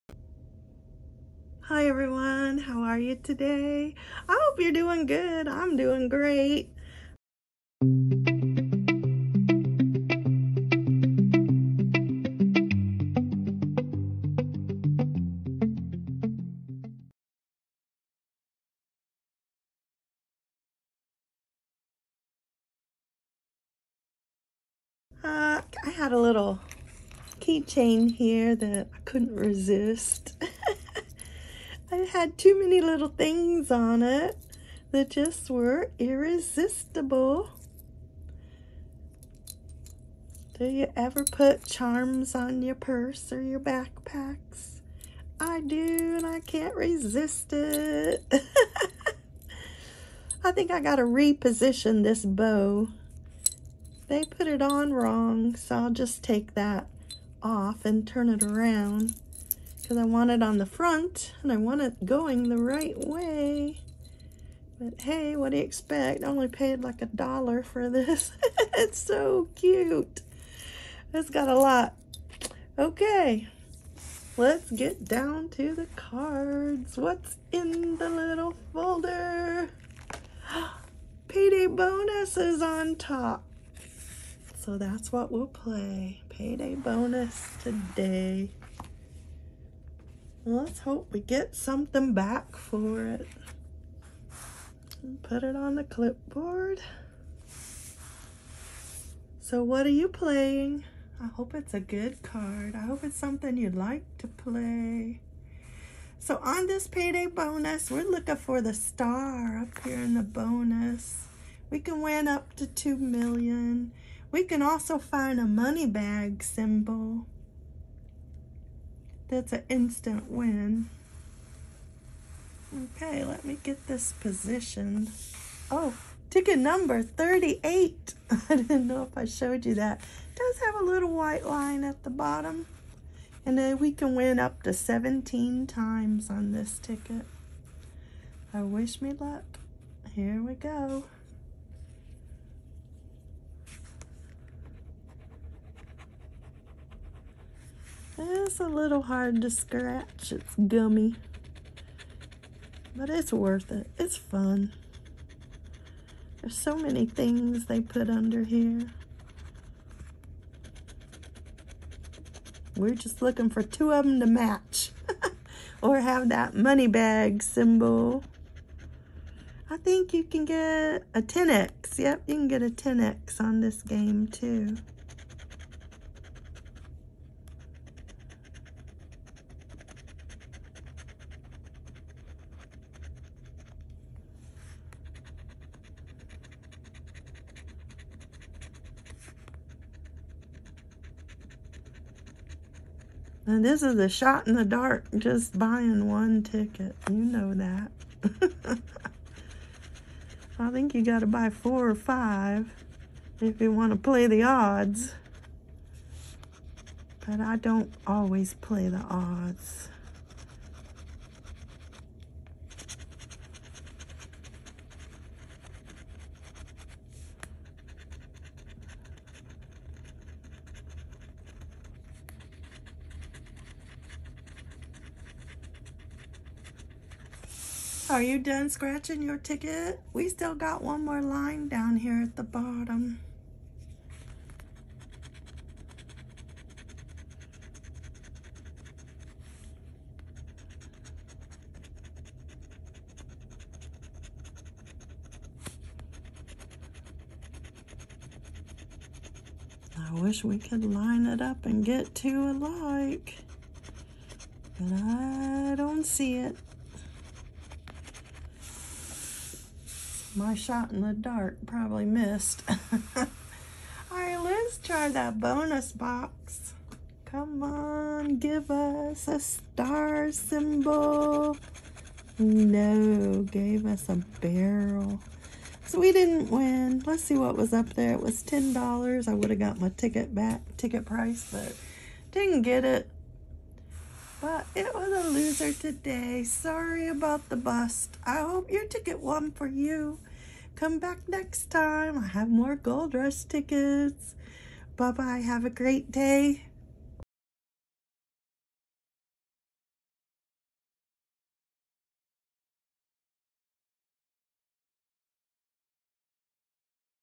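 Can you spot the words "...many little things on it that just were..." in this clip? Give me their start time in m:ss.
0:32.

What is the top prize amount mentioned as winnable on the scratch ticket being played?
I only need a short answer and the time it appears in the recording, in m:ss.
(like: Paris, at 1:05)
2 million, at 1:52.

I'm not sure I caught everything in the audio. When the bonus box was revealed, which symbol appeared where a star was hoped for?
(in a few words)
barrel.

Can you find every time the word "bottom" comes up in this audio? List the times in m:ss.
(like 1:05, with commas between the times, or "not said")
2:12, 3:52.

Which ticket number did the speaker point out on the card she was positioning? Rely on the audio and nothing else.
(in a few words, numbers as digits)
38.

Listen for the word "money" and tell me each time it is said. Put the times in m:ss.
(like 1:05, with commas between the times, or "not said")
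1:55, 2:46.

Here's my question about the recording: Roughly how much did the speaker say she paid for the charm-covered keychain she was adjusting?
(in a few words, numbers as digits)
$1.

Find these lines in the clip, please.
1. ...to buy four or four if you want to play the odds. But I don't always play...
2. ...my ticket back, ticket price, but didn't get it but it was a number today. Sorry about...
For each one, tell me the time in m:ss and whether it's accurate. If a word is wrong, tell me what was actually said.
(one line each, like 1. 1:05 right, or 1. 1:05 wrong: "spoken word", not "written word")
1. 3:21 wrong: "five", not "four"
2. 4:39 wrong: "loser", not "number".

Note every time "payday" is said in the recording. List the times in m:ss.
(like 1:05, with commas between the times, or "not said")
1:21, 1:26, 1:46.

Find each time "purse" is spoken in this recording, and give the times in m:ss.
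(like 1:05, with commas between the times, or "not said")
0:42.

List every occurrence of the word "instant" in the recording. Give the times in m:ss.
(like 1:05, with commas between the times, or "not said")
1:59.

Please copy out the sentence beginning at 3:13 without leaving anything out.
And this is a shot in the dark, just buying one ticket.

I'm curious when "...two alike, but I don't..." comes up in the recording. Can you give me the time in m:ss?
4:12.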